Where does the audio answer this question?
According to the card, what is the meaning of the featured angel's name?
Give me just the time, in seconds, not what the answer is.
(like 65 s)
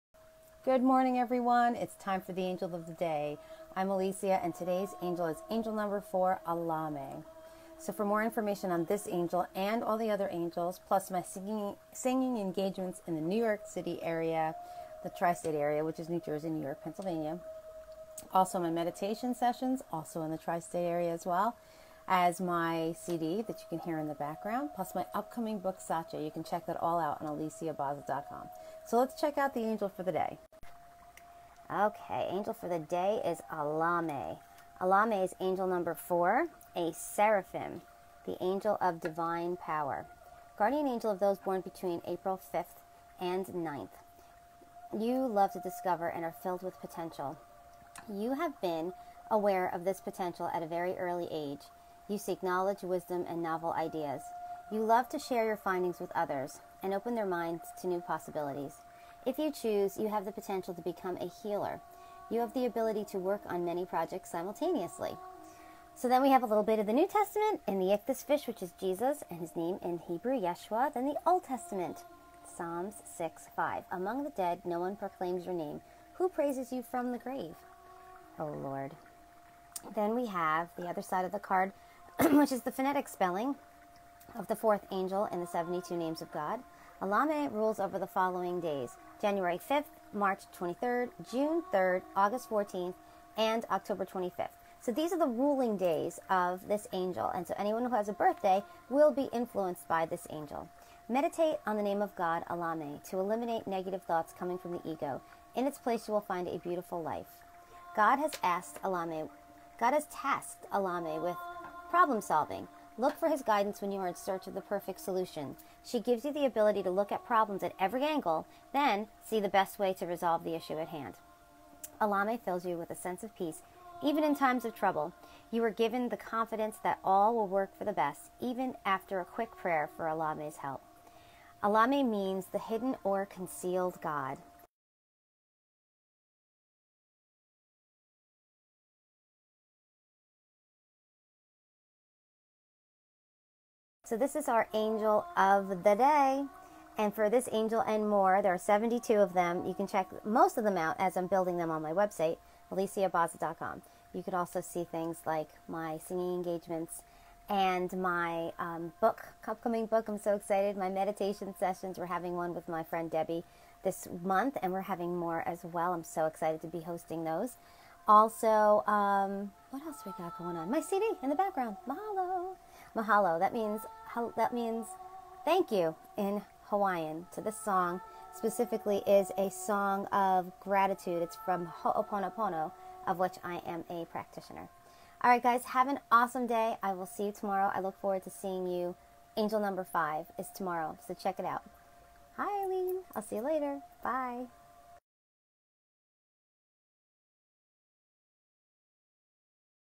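132 s.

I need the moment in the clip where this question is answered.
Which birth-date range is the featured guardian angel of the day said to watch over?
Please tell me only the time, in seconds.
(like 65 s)
42 s.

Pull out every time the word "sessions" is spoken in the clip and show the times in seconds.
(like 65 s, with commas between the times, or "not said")
19 s, 161 s.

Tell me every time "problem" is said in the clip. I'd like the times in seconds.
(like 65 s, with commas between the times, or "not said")
111 s, 117 s.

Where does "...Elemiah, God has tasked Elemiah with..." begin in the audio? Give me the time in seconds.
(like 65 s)
108 s.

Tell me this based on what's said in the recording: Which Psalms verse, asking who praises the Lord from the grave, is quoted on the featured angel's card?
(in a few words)
Psalms 6:5.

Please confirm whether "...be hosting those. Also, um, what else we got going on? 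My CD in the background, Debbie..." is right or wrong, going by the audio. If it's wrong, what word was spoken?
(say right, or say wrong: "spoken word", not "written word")
wrong: "Mahalo", not "Debbie".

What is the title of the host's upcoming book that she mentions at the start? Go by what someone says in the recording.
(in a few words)
Satya.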